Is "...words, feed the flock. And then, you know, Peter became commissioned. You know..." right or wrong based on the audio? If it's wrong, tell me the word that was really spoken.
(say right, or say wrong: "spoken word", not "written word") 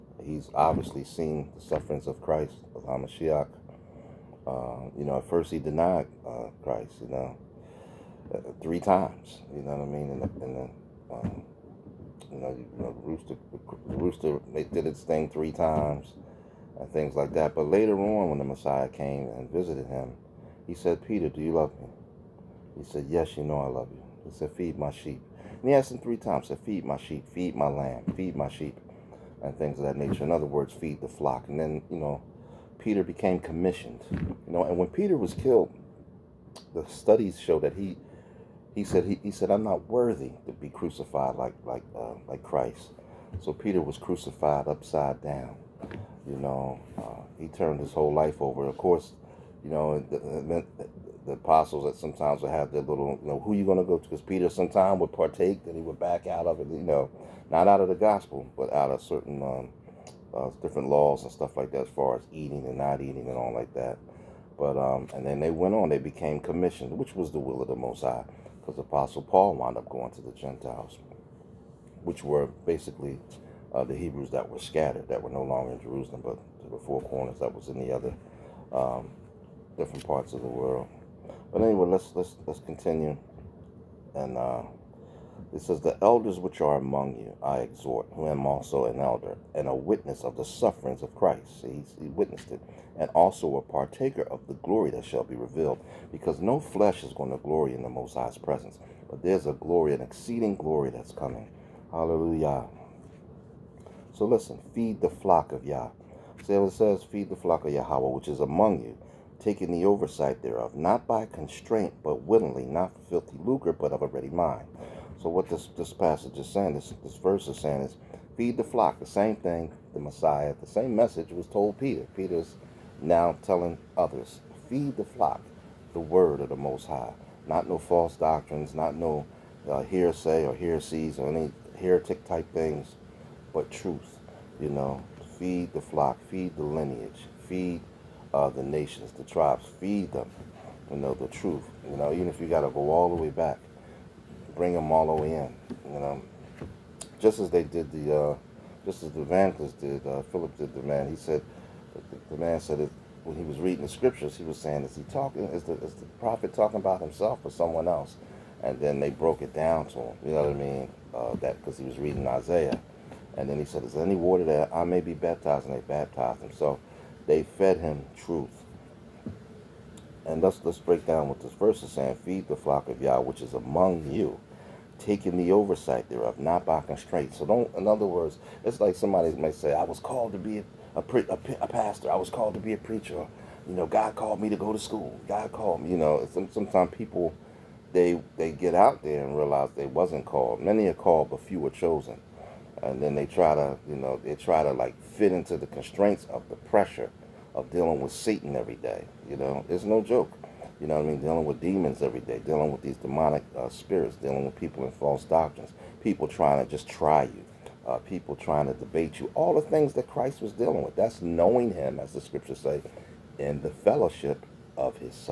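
right.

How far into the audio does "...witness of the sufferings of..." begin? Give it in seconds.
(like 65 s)
89 s.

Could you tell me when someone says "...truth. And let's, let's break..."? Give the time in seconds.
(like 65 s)
168 s.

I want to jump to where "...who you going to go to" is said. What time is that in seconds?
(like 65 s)
53 s.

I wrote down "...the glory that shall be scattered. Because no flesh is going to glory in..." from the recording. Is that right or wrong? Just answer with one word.
wrong.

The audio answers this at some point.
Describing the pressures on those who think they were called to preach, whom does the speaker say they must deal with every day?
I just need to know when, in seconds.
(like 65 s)
198 s.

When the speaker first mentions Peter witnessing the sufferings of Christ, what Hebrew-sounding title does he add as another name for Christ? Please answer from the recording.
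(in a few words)
Hamashiach.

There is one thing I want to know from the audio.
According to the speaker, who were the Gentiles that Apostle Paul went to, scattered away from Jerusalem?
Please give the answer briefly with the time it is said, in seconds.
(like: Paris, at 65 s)
The Hebrews, at 73 s.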